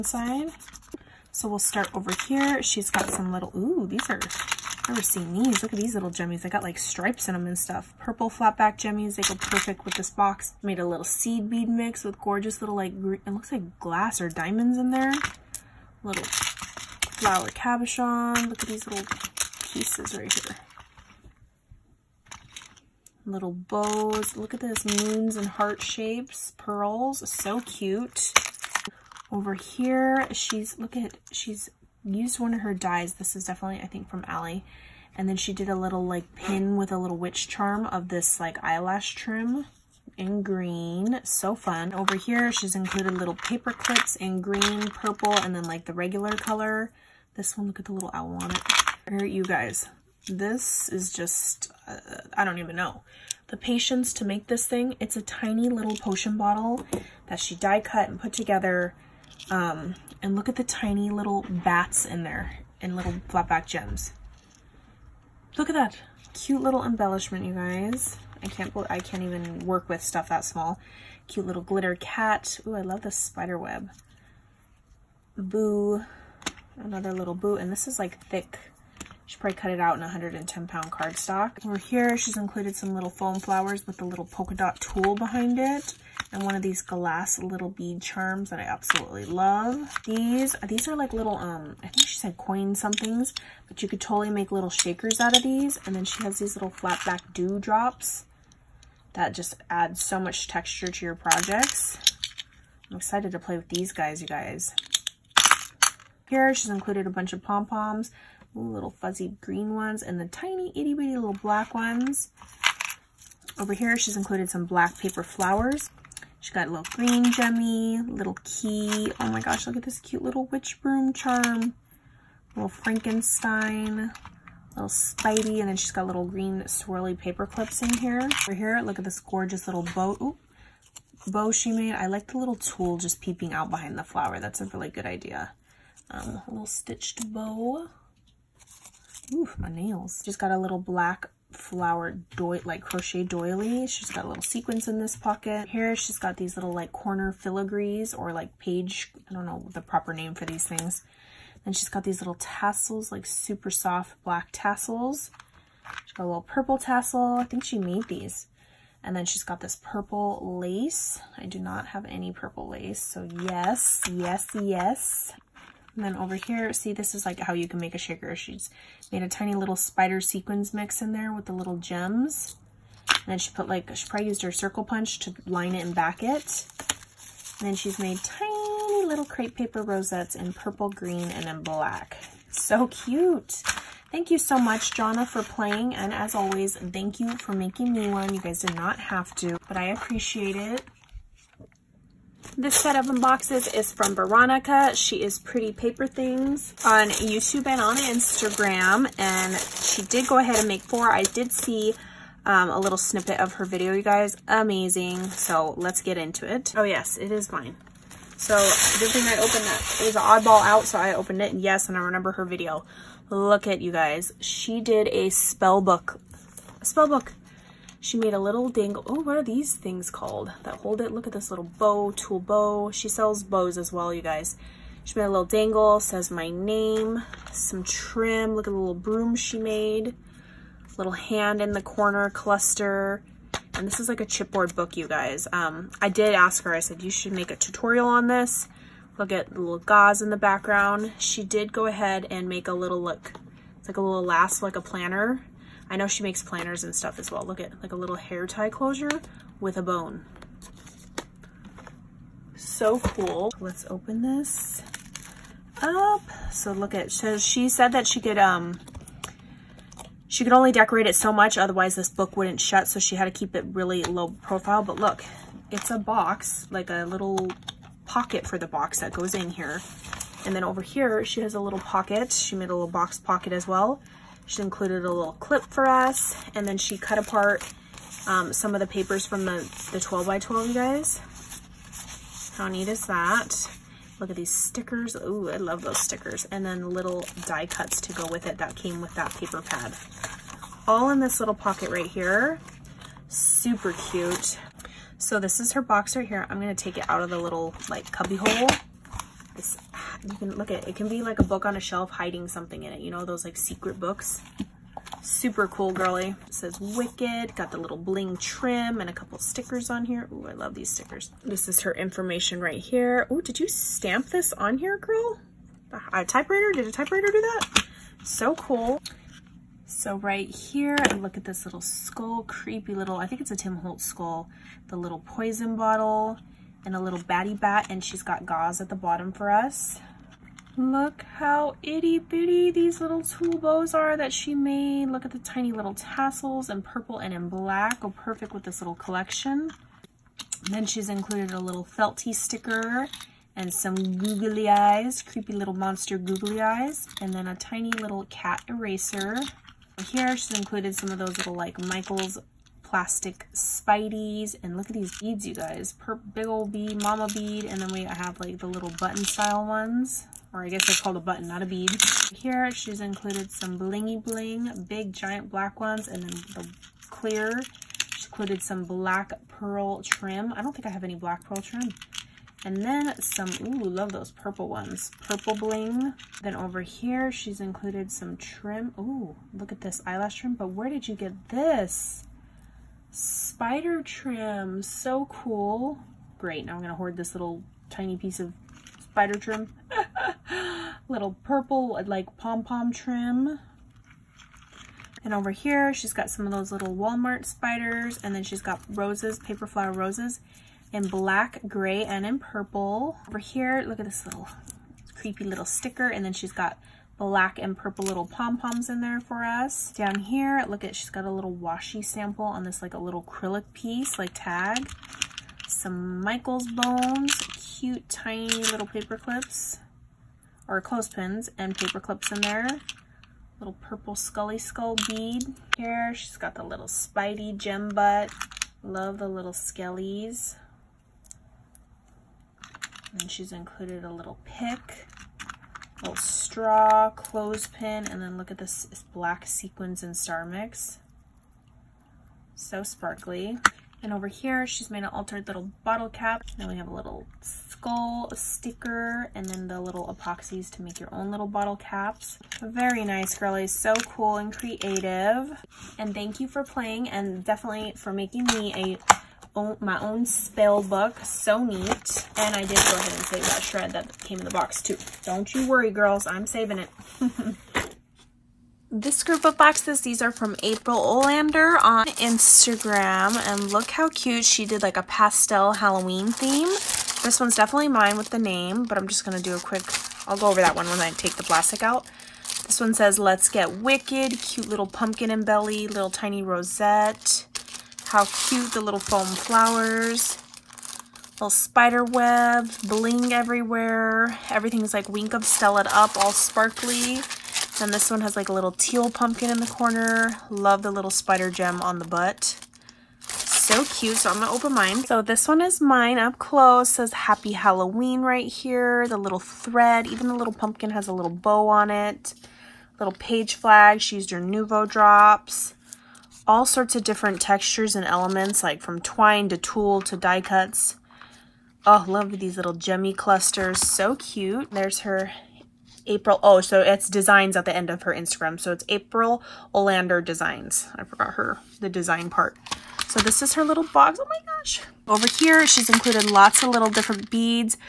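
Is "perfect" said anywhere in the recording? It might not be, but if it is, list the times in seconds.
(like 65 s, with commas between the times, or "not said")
9 s, 338 s.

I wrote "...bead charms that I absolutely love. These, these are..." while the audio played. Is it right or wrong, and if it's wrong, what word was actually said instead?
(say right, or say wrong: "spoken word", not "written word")
right.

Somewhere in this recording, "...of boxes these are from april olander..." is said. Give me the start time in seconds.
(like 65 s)
469 s.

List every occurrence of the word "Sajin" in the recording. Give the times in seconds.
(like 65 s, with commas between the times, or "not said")
not said.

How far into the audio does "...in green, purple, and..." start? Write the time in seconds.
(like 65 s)
44 s.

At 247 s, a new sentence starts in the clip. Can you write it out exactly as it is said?
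Look at like a little hair tie closure with a bone.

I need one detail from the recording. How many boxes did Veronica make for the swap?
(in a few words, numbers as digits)
4.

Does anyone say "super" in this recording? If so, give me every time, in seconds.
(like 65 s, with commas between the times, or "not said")
153 s, 293 s, 305 s.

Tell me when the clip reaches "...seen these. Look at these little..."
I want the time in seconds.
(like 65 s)
5 s.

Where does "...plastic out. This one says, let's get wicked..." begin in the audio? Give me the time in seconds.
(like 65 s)
481 s.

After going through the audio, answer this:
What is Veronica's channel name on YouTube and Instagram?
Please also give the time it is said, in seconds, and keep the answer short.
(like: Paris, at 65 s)
Pretty Paper Things, at 195 s.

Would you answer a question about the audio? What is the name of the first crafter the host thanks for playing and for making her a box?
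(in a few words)
Johnna.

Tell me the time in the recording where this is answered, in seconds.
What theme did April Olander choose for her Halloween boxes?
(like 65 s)
475 s.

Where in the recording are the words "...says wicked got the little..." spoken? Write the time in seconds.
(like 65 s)
306 s.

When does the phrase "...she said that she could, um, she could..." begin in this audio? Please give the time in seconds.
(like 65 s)
257 s.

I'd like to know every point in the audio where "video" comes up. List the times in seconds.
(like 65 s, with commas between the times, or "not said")
203 s, 212 s.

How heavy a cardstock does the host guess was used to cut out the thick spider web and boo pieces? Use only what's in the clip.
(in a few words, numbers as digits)
110 pound.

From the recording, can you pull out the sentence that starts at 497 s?
Then this one has like a little teal pumpkin in the corner.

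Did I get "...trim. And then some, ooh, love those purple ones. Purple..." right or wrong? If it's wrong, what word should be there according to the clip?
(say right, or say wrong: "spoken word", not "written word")
right.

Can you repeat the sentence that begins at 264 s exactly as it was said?
But look, it's a box, like a little pocket for the box that goes in here.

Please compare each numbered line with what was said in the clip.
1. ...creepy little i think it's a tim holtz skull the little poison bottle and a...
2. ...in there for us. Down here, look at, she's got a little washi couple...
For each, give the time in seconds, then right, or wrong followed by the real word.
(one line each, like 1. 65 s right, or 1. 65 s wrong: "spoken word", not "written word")
1. 322 s right
2. 408 s wrong: "sample", not "couple".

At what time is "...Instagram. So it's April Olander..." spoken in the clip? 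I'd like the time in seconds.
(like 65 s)
528 s.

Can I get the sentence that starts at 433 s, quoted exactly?
And she's included a little pick, little straw, clothespin, and then look at this black sequins and star mix.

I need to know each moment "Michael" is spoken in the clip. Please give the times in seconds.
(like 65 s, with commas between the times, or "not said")
351 s, 416 s.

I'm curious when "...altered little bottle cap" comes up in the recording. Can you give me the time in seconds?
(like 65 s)
445 s.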